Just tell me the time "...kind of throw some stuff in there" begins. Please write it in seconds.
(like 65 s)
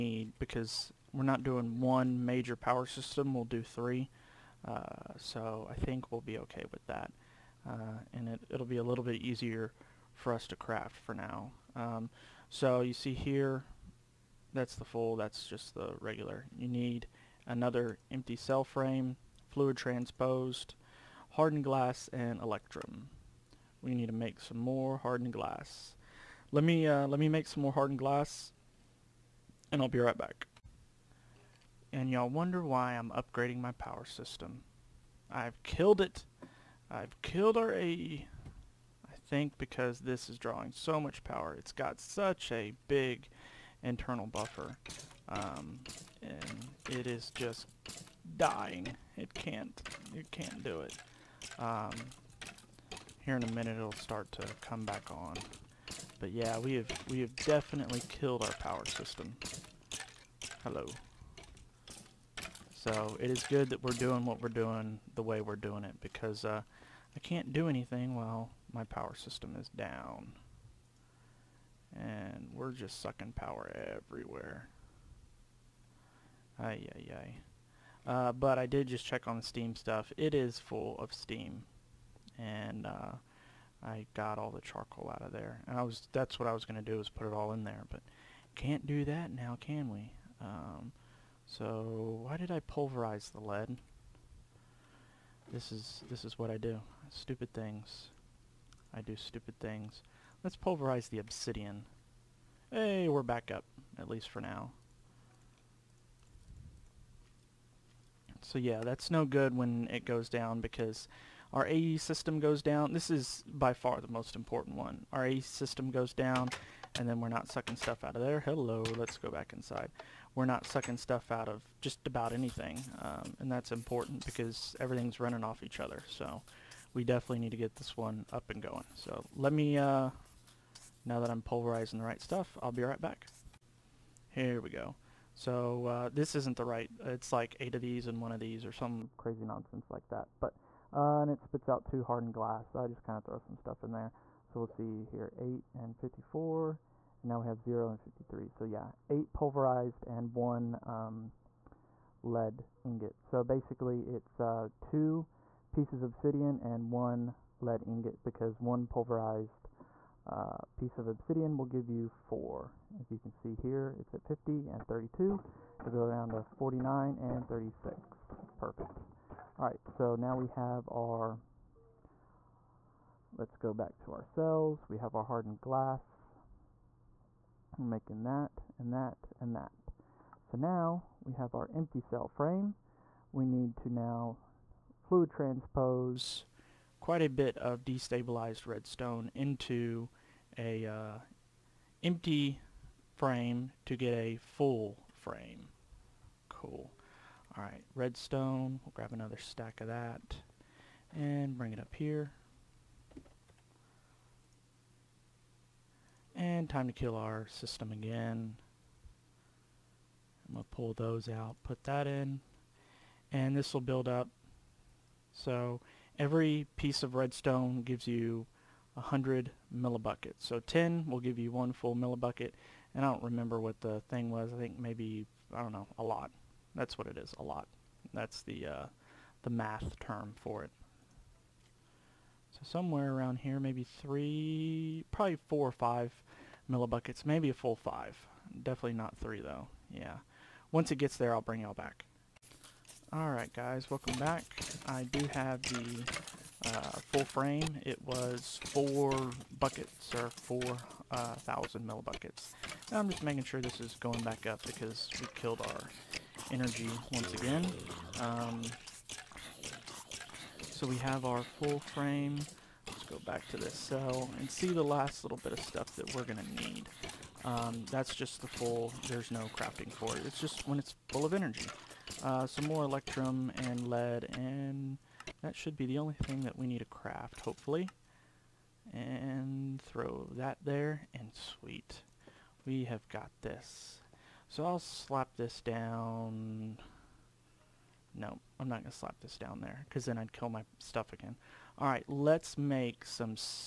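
143 s.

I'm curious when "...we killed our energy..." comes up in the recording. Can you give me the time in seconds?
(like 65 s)
255 s.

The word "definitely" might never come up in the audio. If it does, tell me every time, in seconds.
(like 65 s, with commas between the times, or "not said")
57 s, 127 s, 238 s.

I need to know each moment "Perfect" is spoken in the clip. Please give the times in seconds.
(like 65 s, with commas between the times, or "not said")
168 s.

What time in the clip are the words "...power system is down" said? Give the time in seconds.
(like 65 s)
68 s.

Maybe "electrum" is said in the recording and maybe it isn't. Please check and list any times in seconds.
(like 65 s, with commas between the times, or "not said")
22 s, 272 s.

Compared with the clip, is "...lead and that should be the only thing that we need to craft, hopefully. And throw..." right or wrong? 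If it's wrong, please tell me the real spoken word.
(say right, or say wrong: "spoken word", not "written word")
right.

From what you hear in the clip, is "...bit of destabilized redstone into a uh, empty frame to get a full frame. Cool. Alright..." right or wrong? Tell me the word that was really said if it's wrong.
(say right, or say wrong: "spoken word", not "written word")
right.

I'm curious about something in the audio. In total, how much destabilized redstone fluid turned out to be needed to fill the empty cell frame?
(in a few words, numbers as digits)
4000 millibuckets.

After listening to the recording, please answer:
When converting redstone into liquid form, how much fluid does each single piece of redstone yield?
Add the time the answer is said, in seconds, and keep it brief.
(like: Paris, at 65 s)
100 millibuckets, at 218 s.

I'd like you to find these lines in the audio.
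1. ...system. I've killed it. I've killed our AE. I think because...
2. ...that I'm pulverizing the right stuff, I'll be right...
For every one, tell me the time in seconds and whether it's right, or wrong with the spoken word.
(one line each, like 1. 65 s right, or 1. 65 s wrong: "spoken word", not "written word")
1. 34 s right
2. 131 s right.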